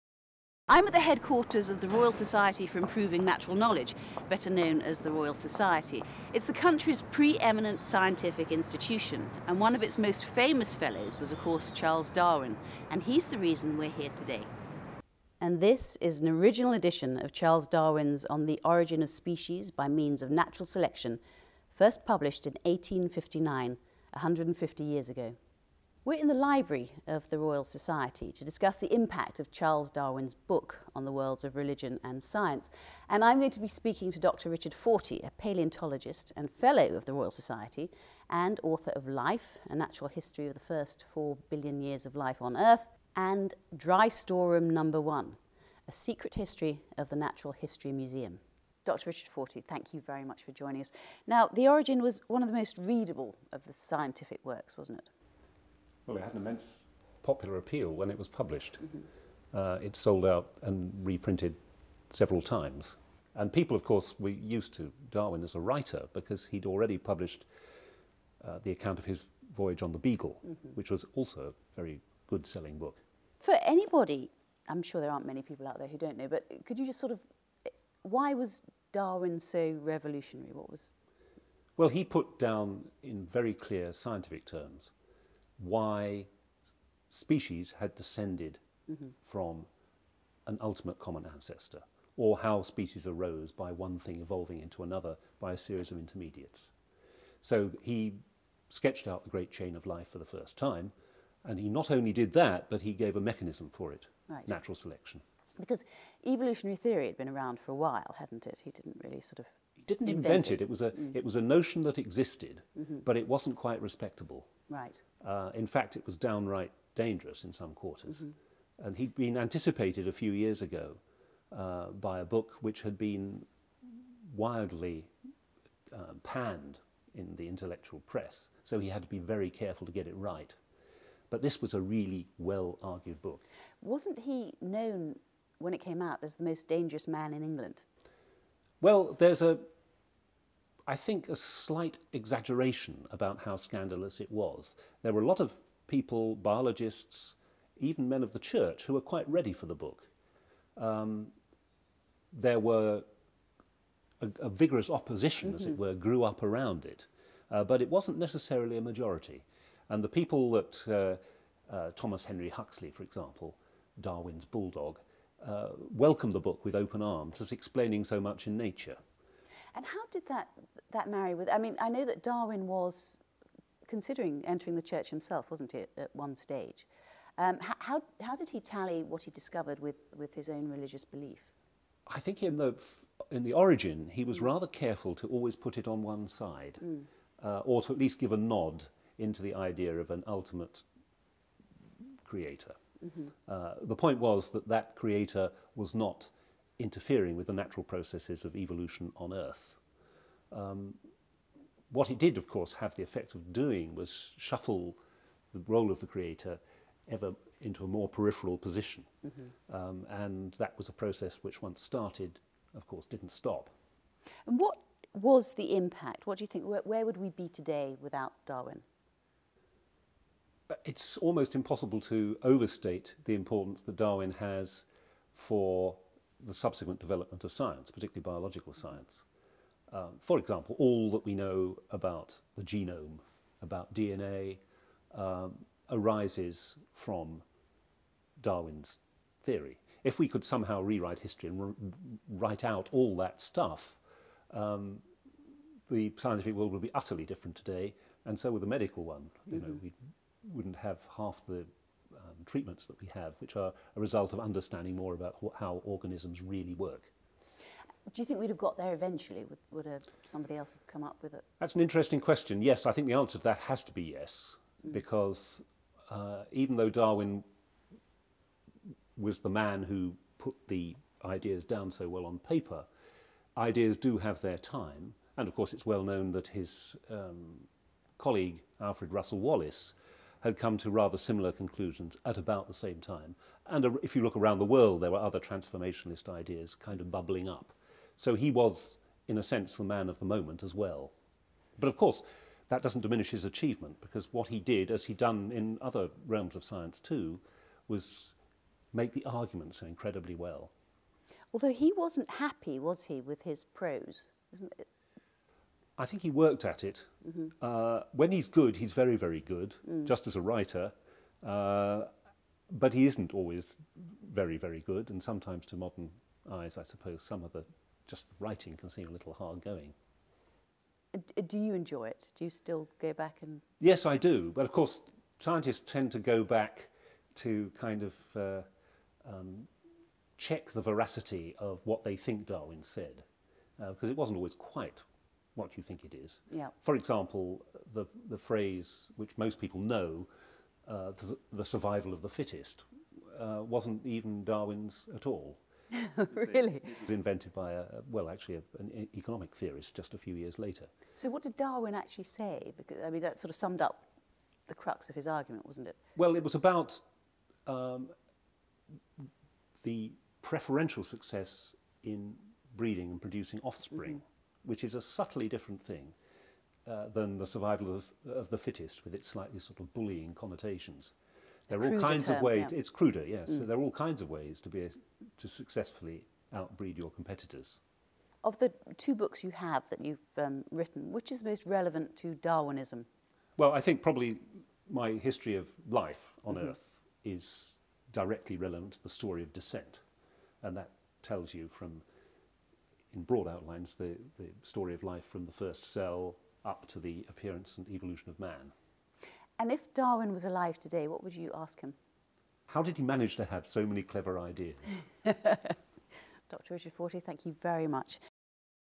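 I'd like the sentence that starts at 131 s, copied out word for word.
But this was a really well argued book.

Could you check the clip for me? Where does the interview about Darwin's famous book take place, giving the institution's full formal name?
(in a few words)
Royal Society for Improving Natural Knowledge.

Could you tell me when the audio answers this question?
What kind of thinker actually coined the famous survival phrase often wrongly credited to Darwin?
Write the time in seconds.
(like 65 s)
349 s.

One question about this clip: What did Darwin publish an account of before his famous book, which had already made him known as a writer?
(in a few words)
His voyage on the Beagle.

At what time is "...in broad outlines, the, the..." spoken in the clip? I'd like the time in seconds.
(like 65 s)
393 s.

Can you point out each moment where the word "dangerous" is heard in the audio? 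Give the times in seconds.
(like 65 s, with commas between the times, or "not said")
116 s, 136 s.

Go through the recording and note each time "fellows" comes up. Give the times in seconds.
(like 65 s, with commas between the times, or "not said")
10 s, 36 s.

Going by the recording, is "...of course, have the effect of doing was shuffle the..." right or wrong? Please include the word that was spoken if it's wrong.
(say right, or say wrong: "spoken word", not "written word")
right.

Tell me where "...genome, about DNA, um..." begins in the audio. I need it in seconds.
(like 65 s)
232 s.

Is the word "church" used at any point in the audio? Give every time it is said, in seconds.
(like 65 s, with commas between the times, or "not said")
148 s, 174 s.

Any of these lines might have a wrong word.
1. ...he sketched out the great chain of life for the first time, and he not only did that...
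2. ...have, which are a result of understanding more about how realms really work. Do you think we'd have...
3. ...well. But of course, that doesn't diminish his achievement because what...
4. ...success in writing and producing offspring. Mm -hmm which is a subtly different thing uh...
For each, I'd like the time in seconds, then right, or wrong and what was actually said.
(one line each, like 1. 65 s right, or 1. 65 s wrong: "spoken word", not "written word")
1. 97 s right
2. 253 s wrong: "organisms", not "realms"
3. 290 s right
4. 361 s wrong: "breeding", not "writing".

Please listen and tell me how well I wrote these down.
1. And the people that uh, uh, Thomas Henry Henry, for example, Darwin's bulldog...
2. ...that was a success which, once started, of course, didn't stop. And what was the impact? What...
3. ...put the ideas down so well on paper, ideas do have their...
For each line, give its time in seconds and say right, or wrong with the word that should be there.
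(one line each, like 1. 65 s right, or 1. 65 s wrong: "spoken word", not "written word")
1. 159 s wrong: "Huxley", not "Henry"
2. 210 s wrong: "process", not "success"
3. 270 s right.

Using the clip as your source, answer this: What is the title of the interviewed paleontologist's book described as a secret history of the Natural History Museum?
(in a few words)
Dry Storeroom Number One.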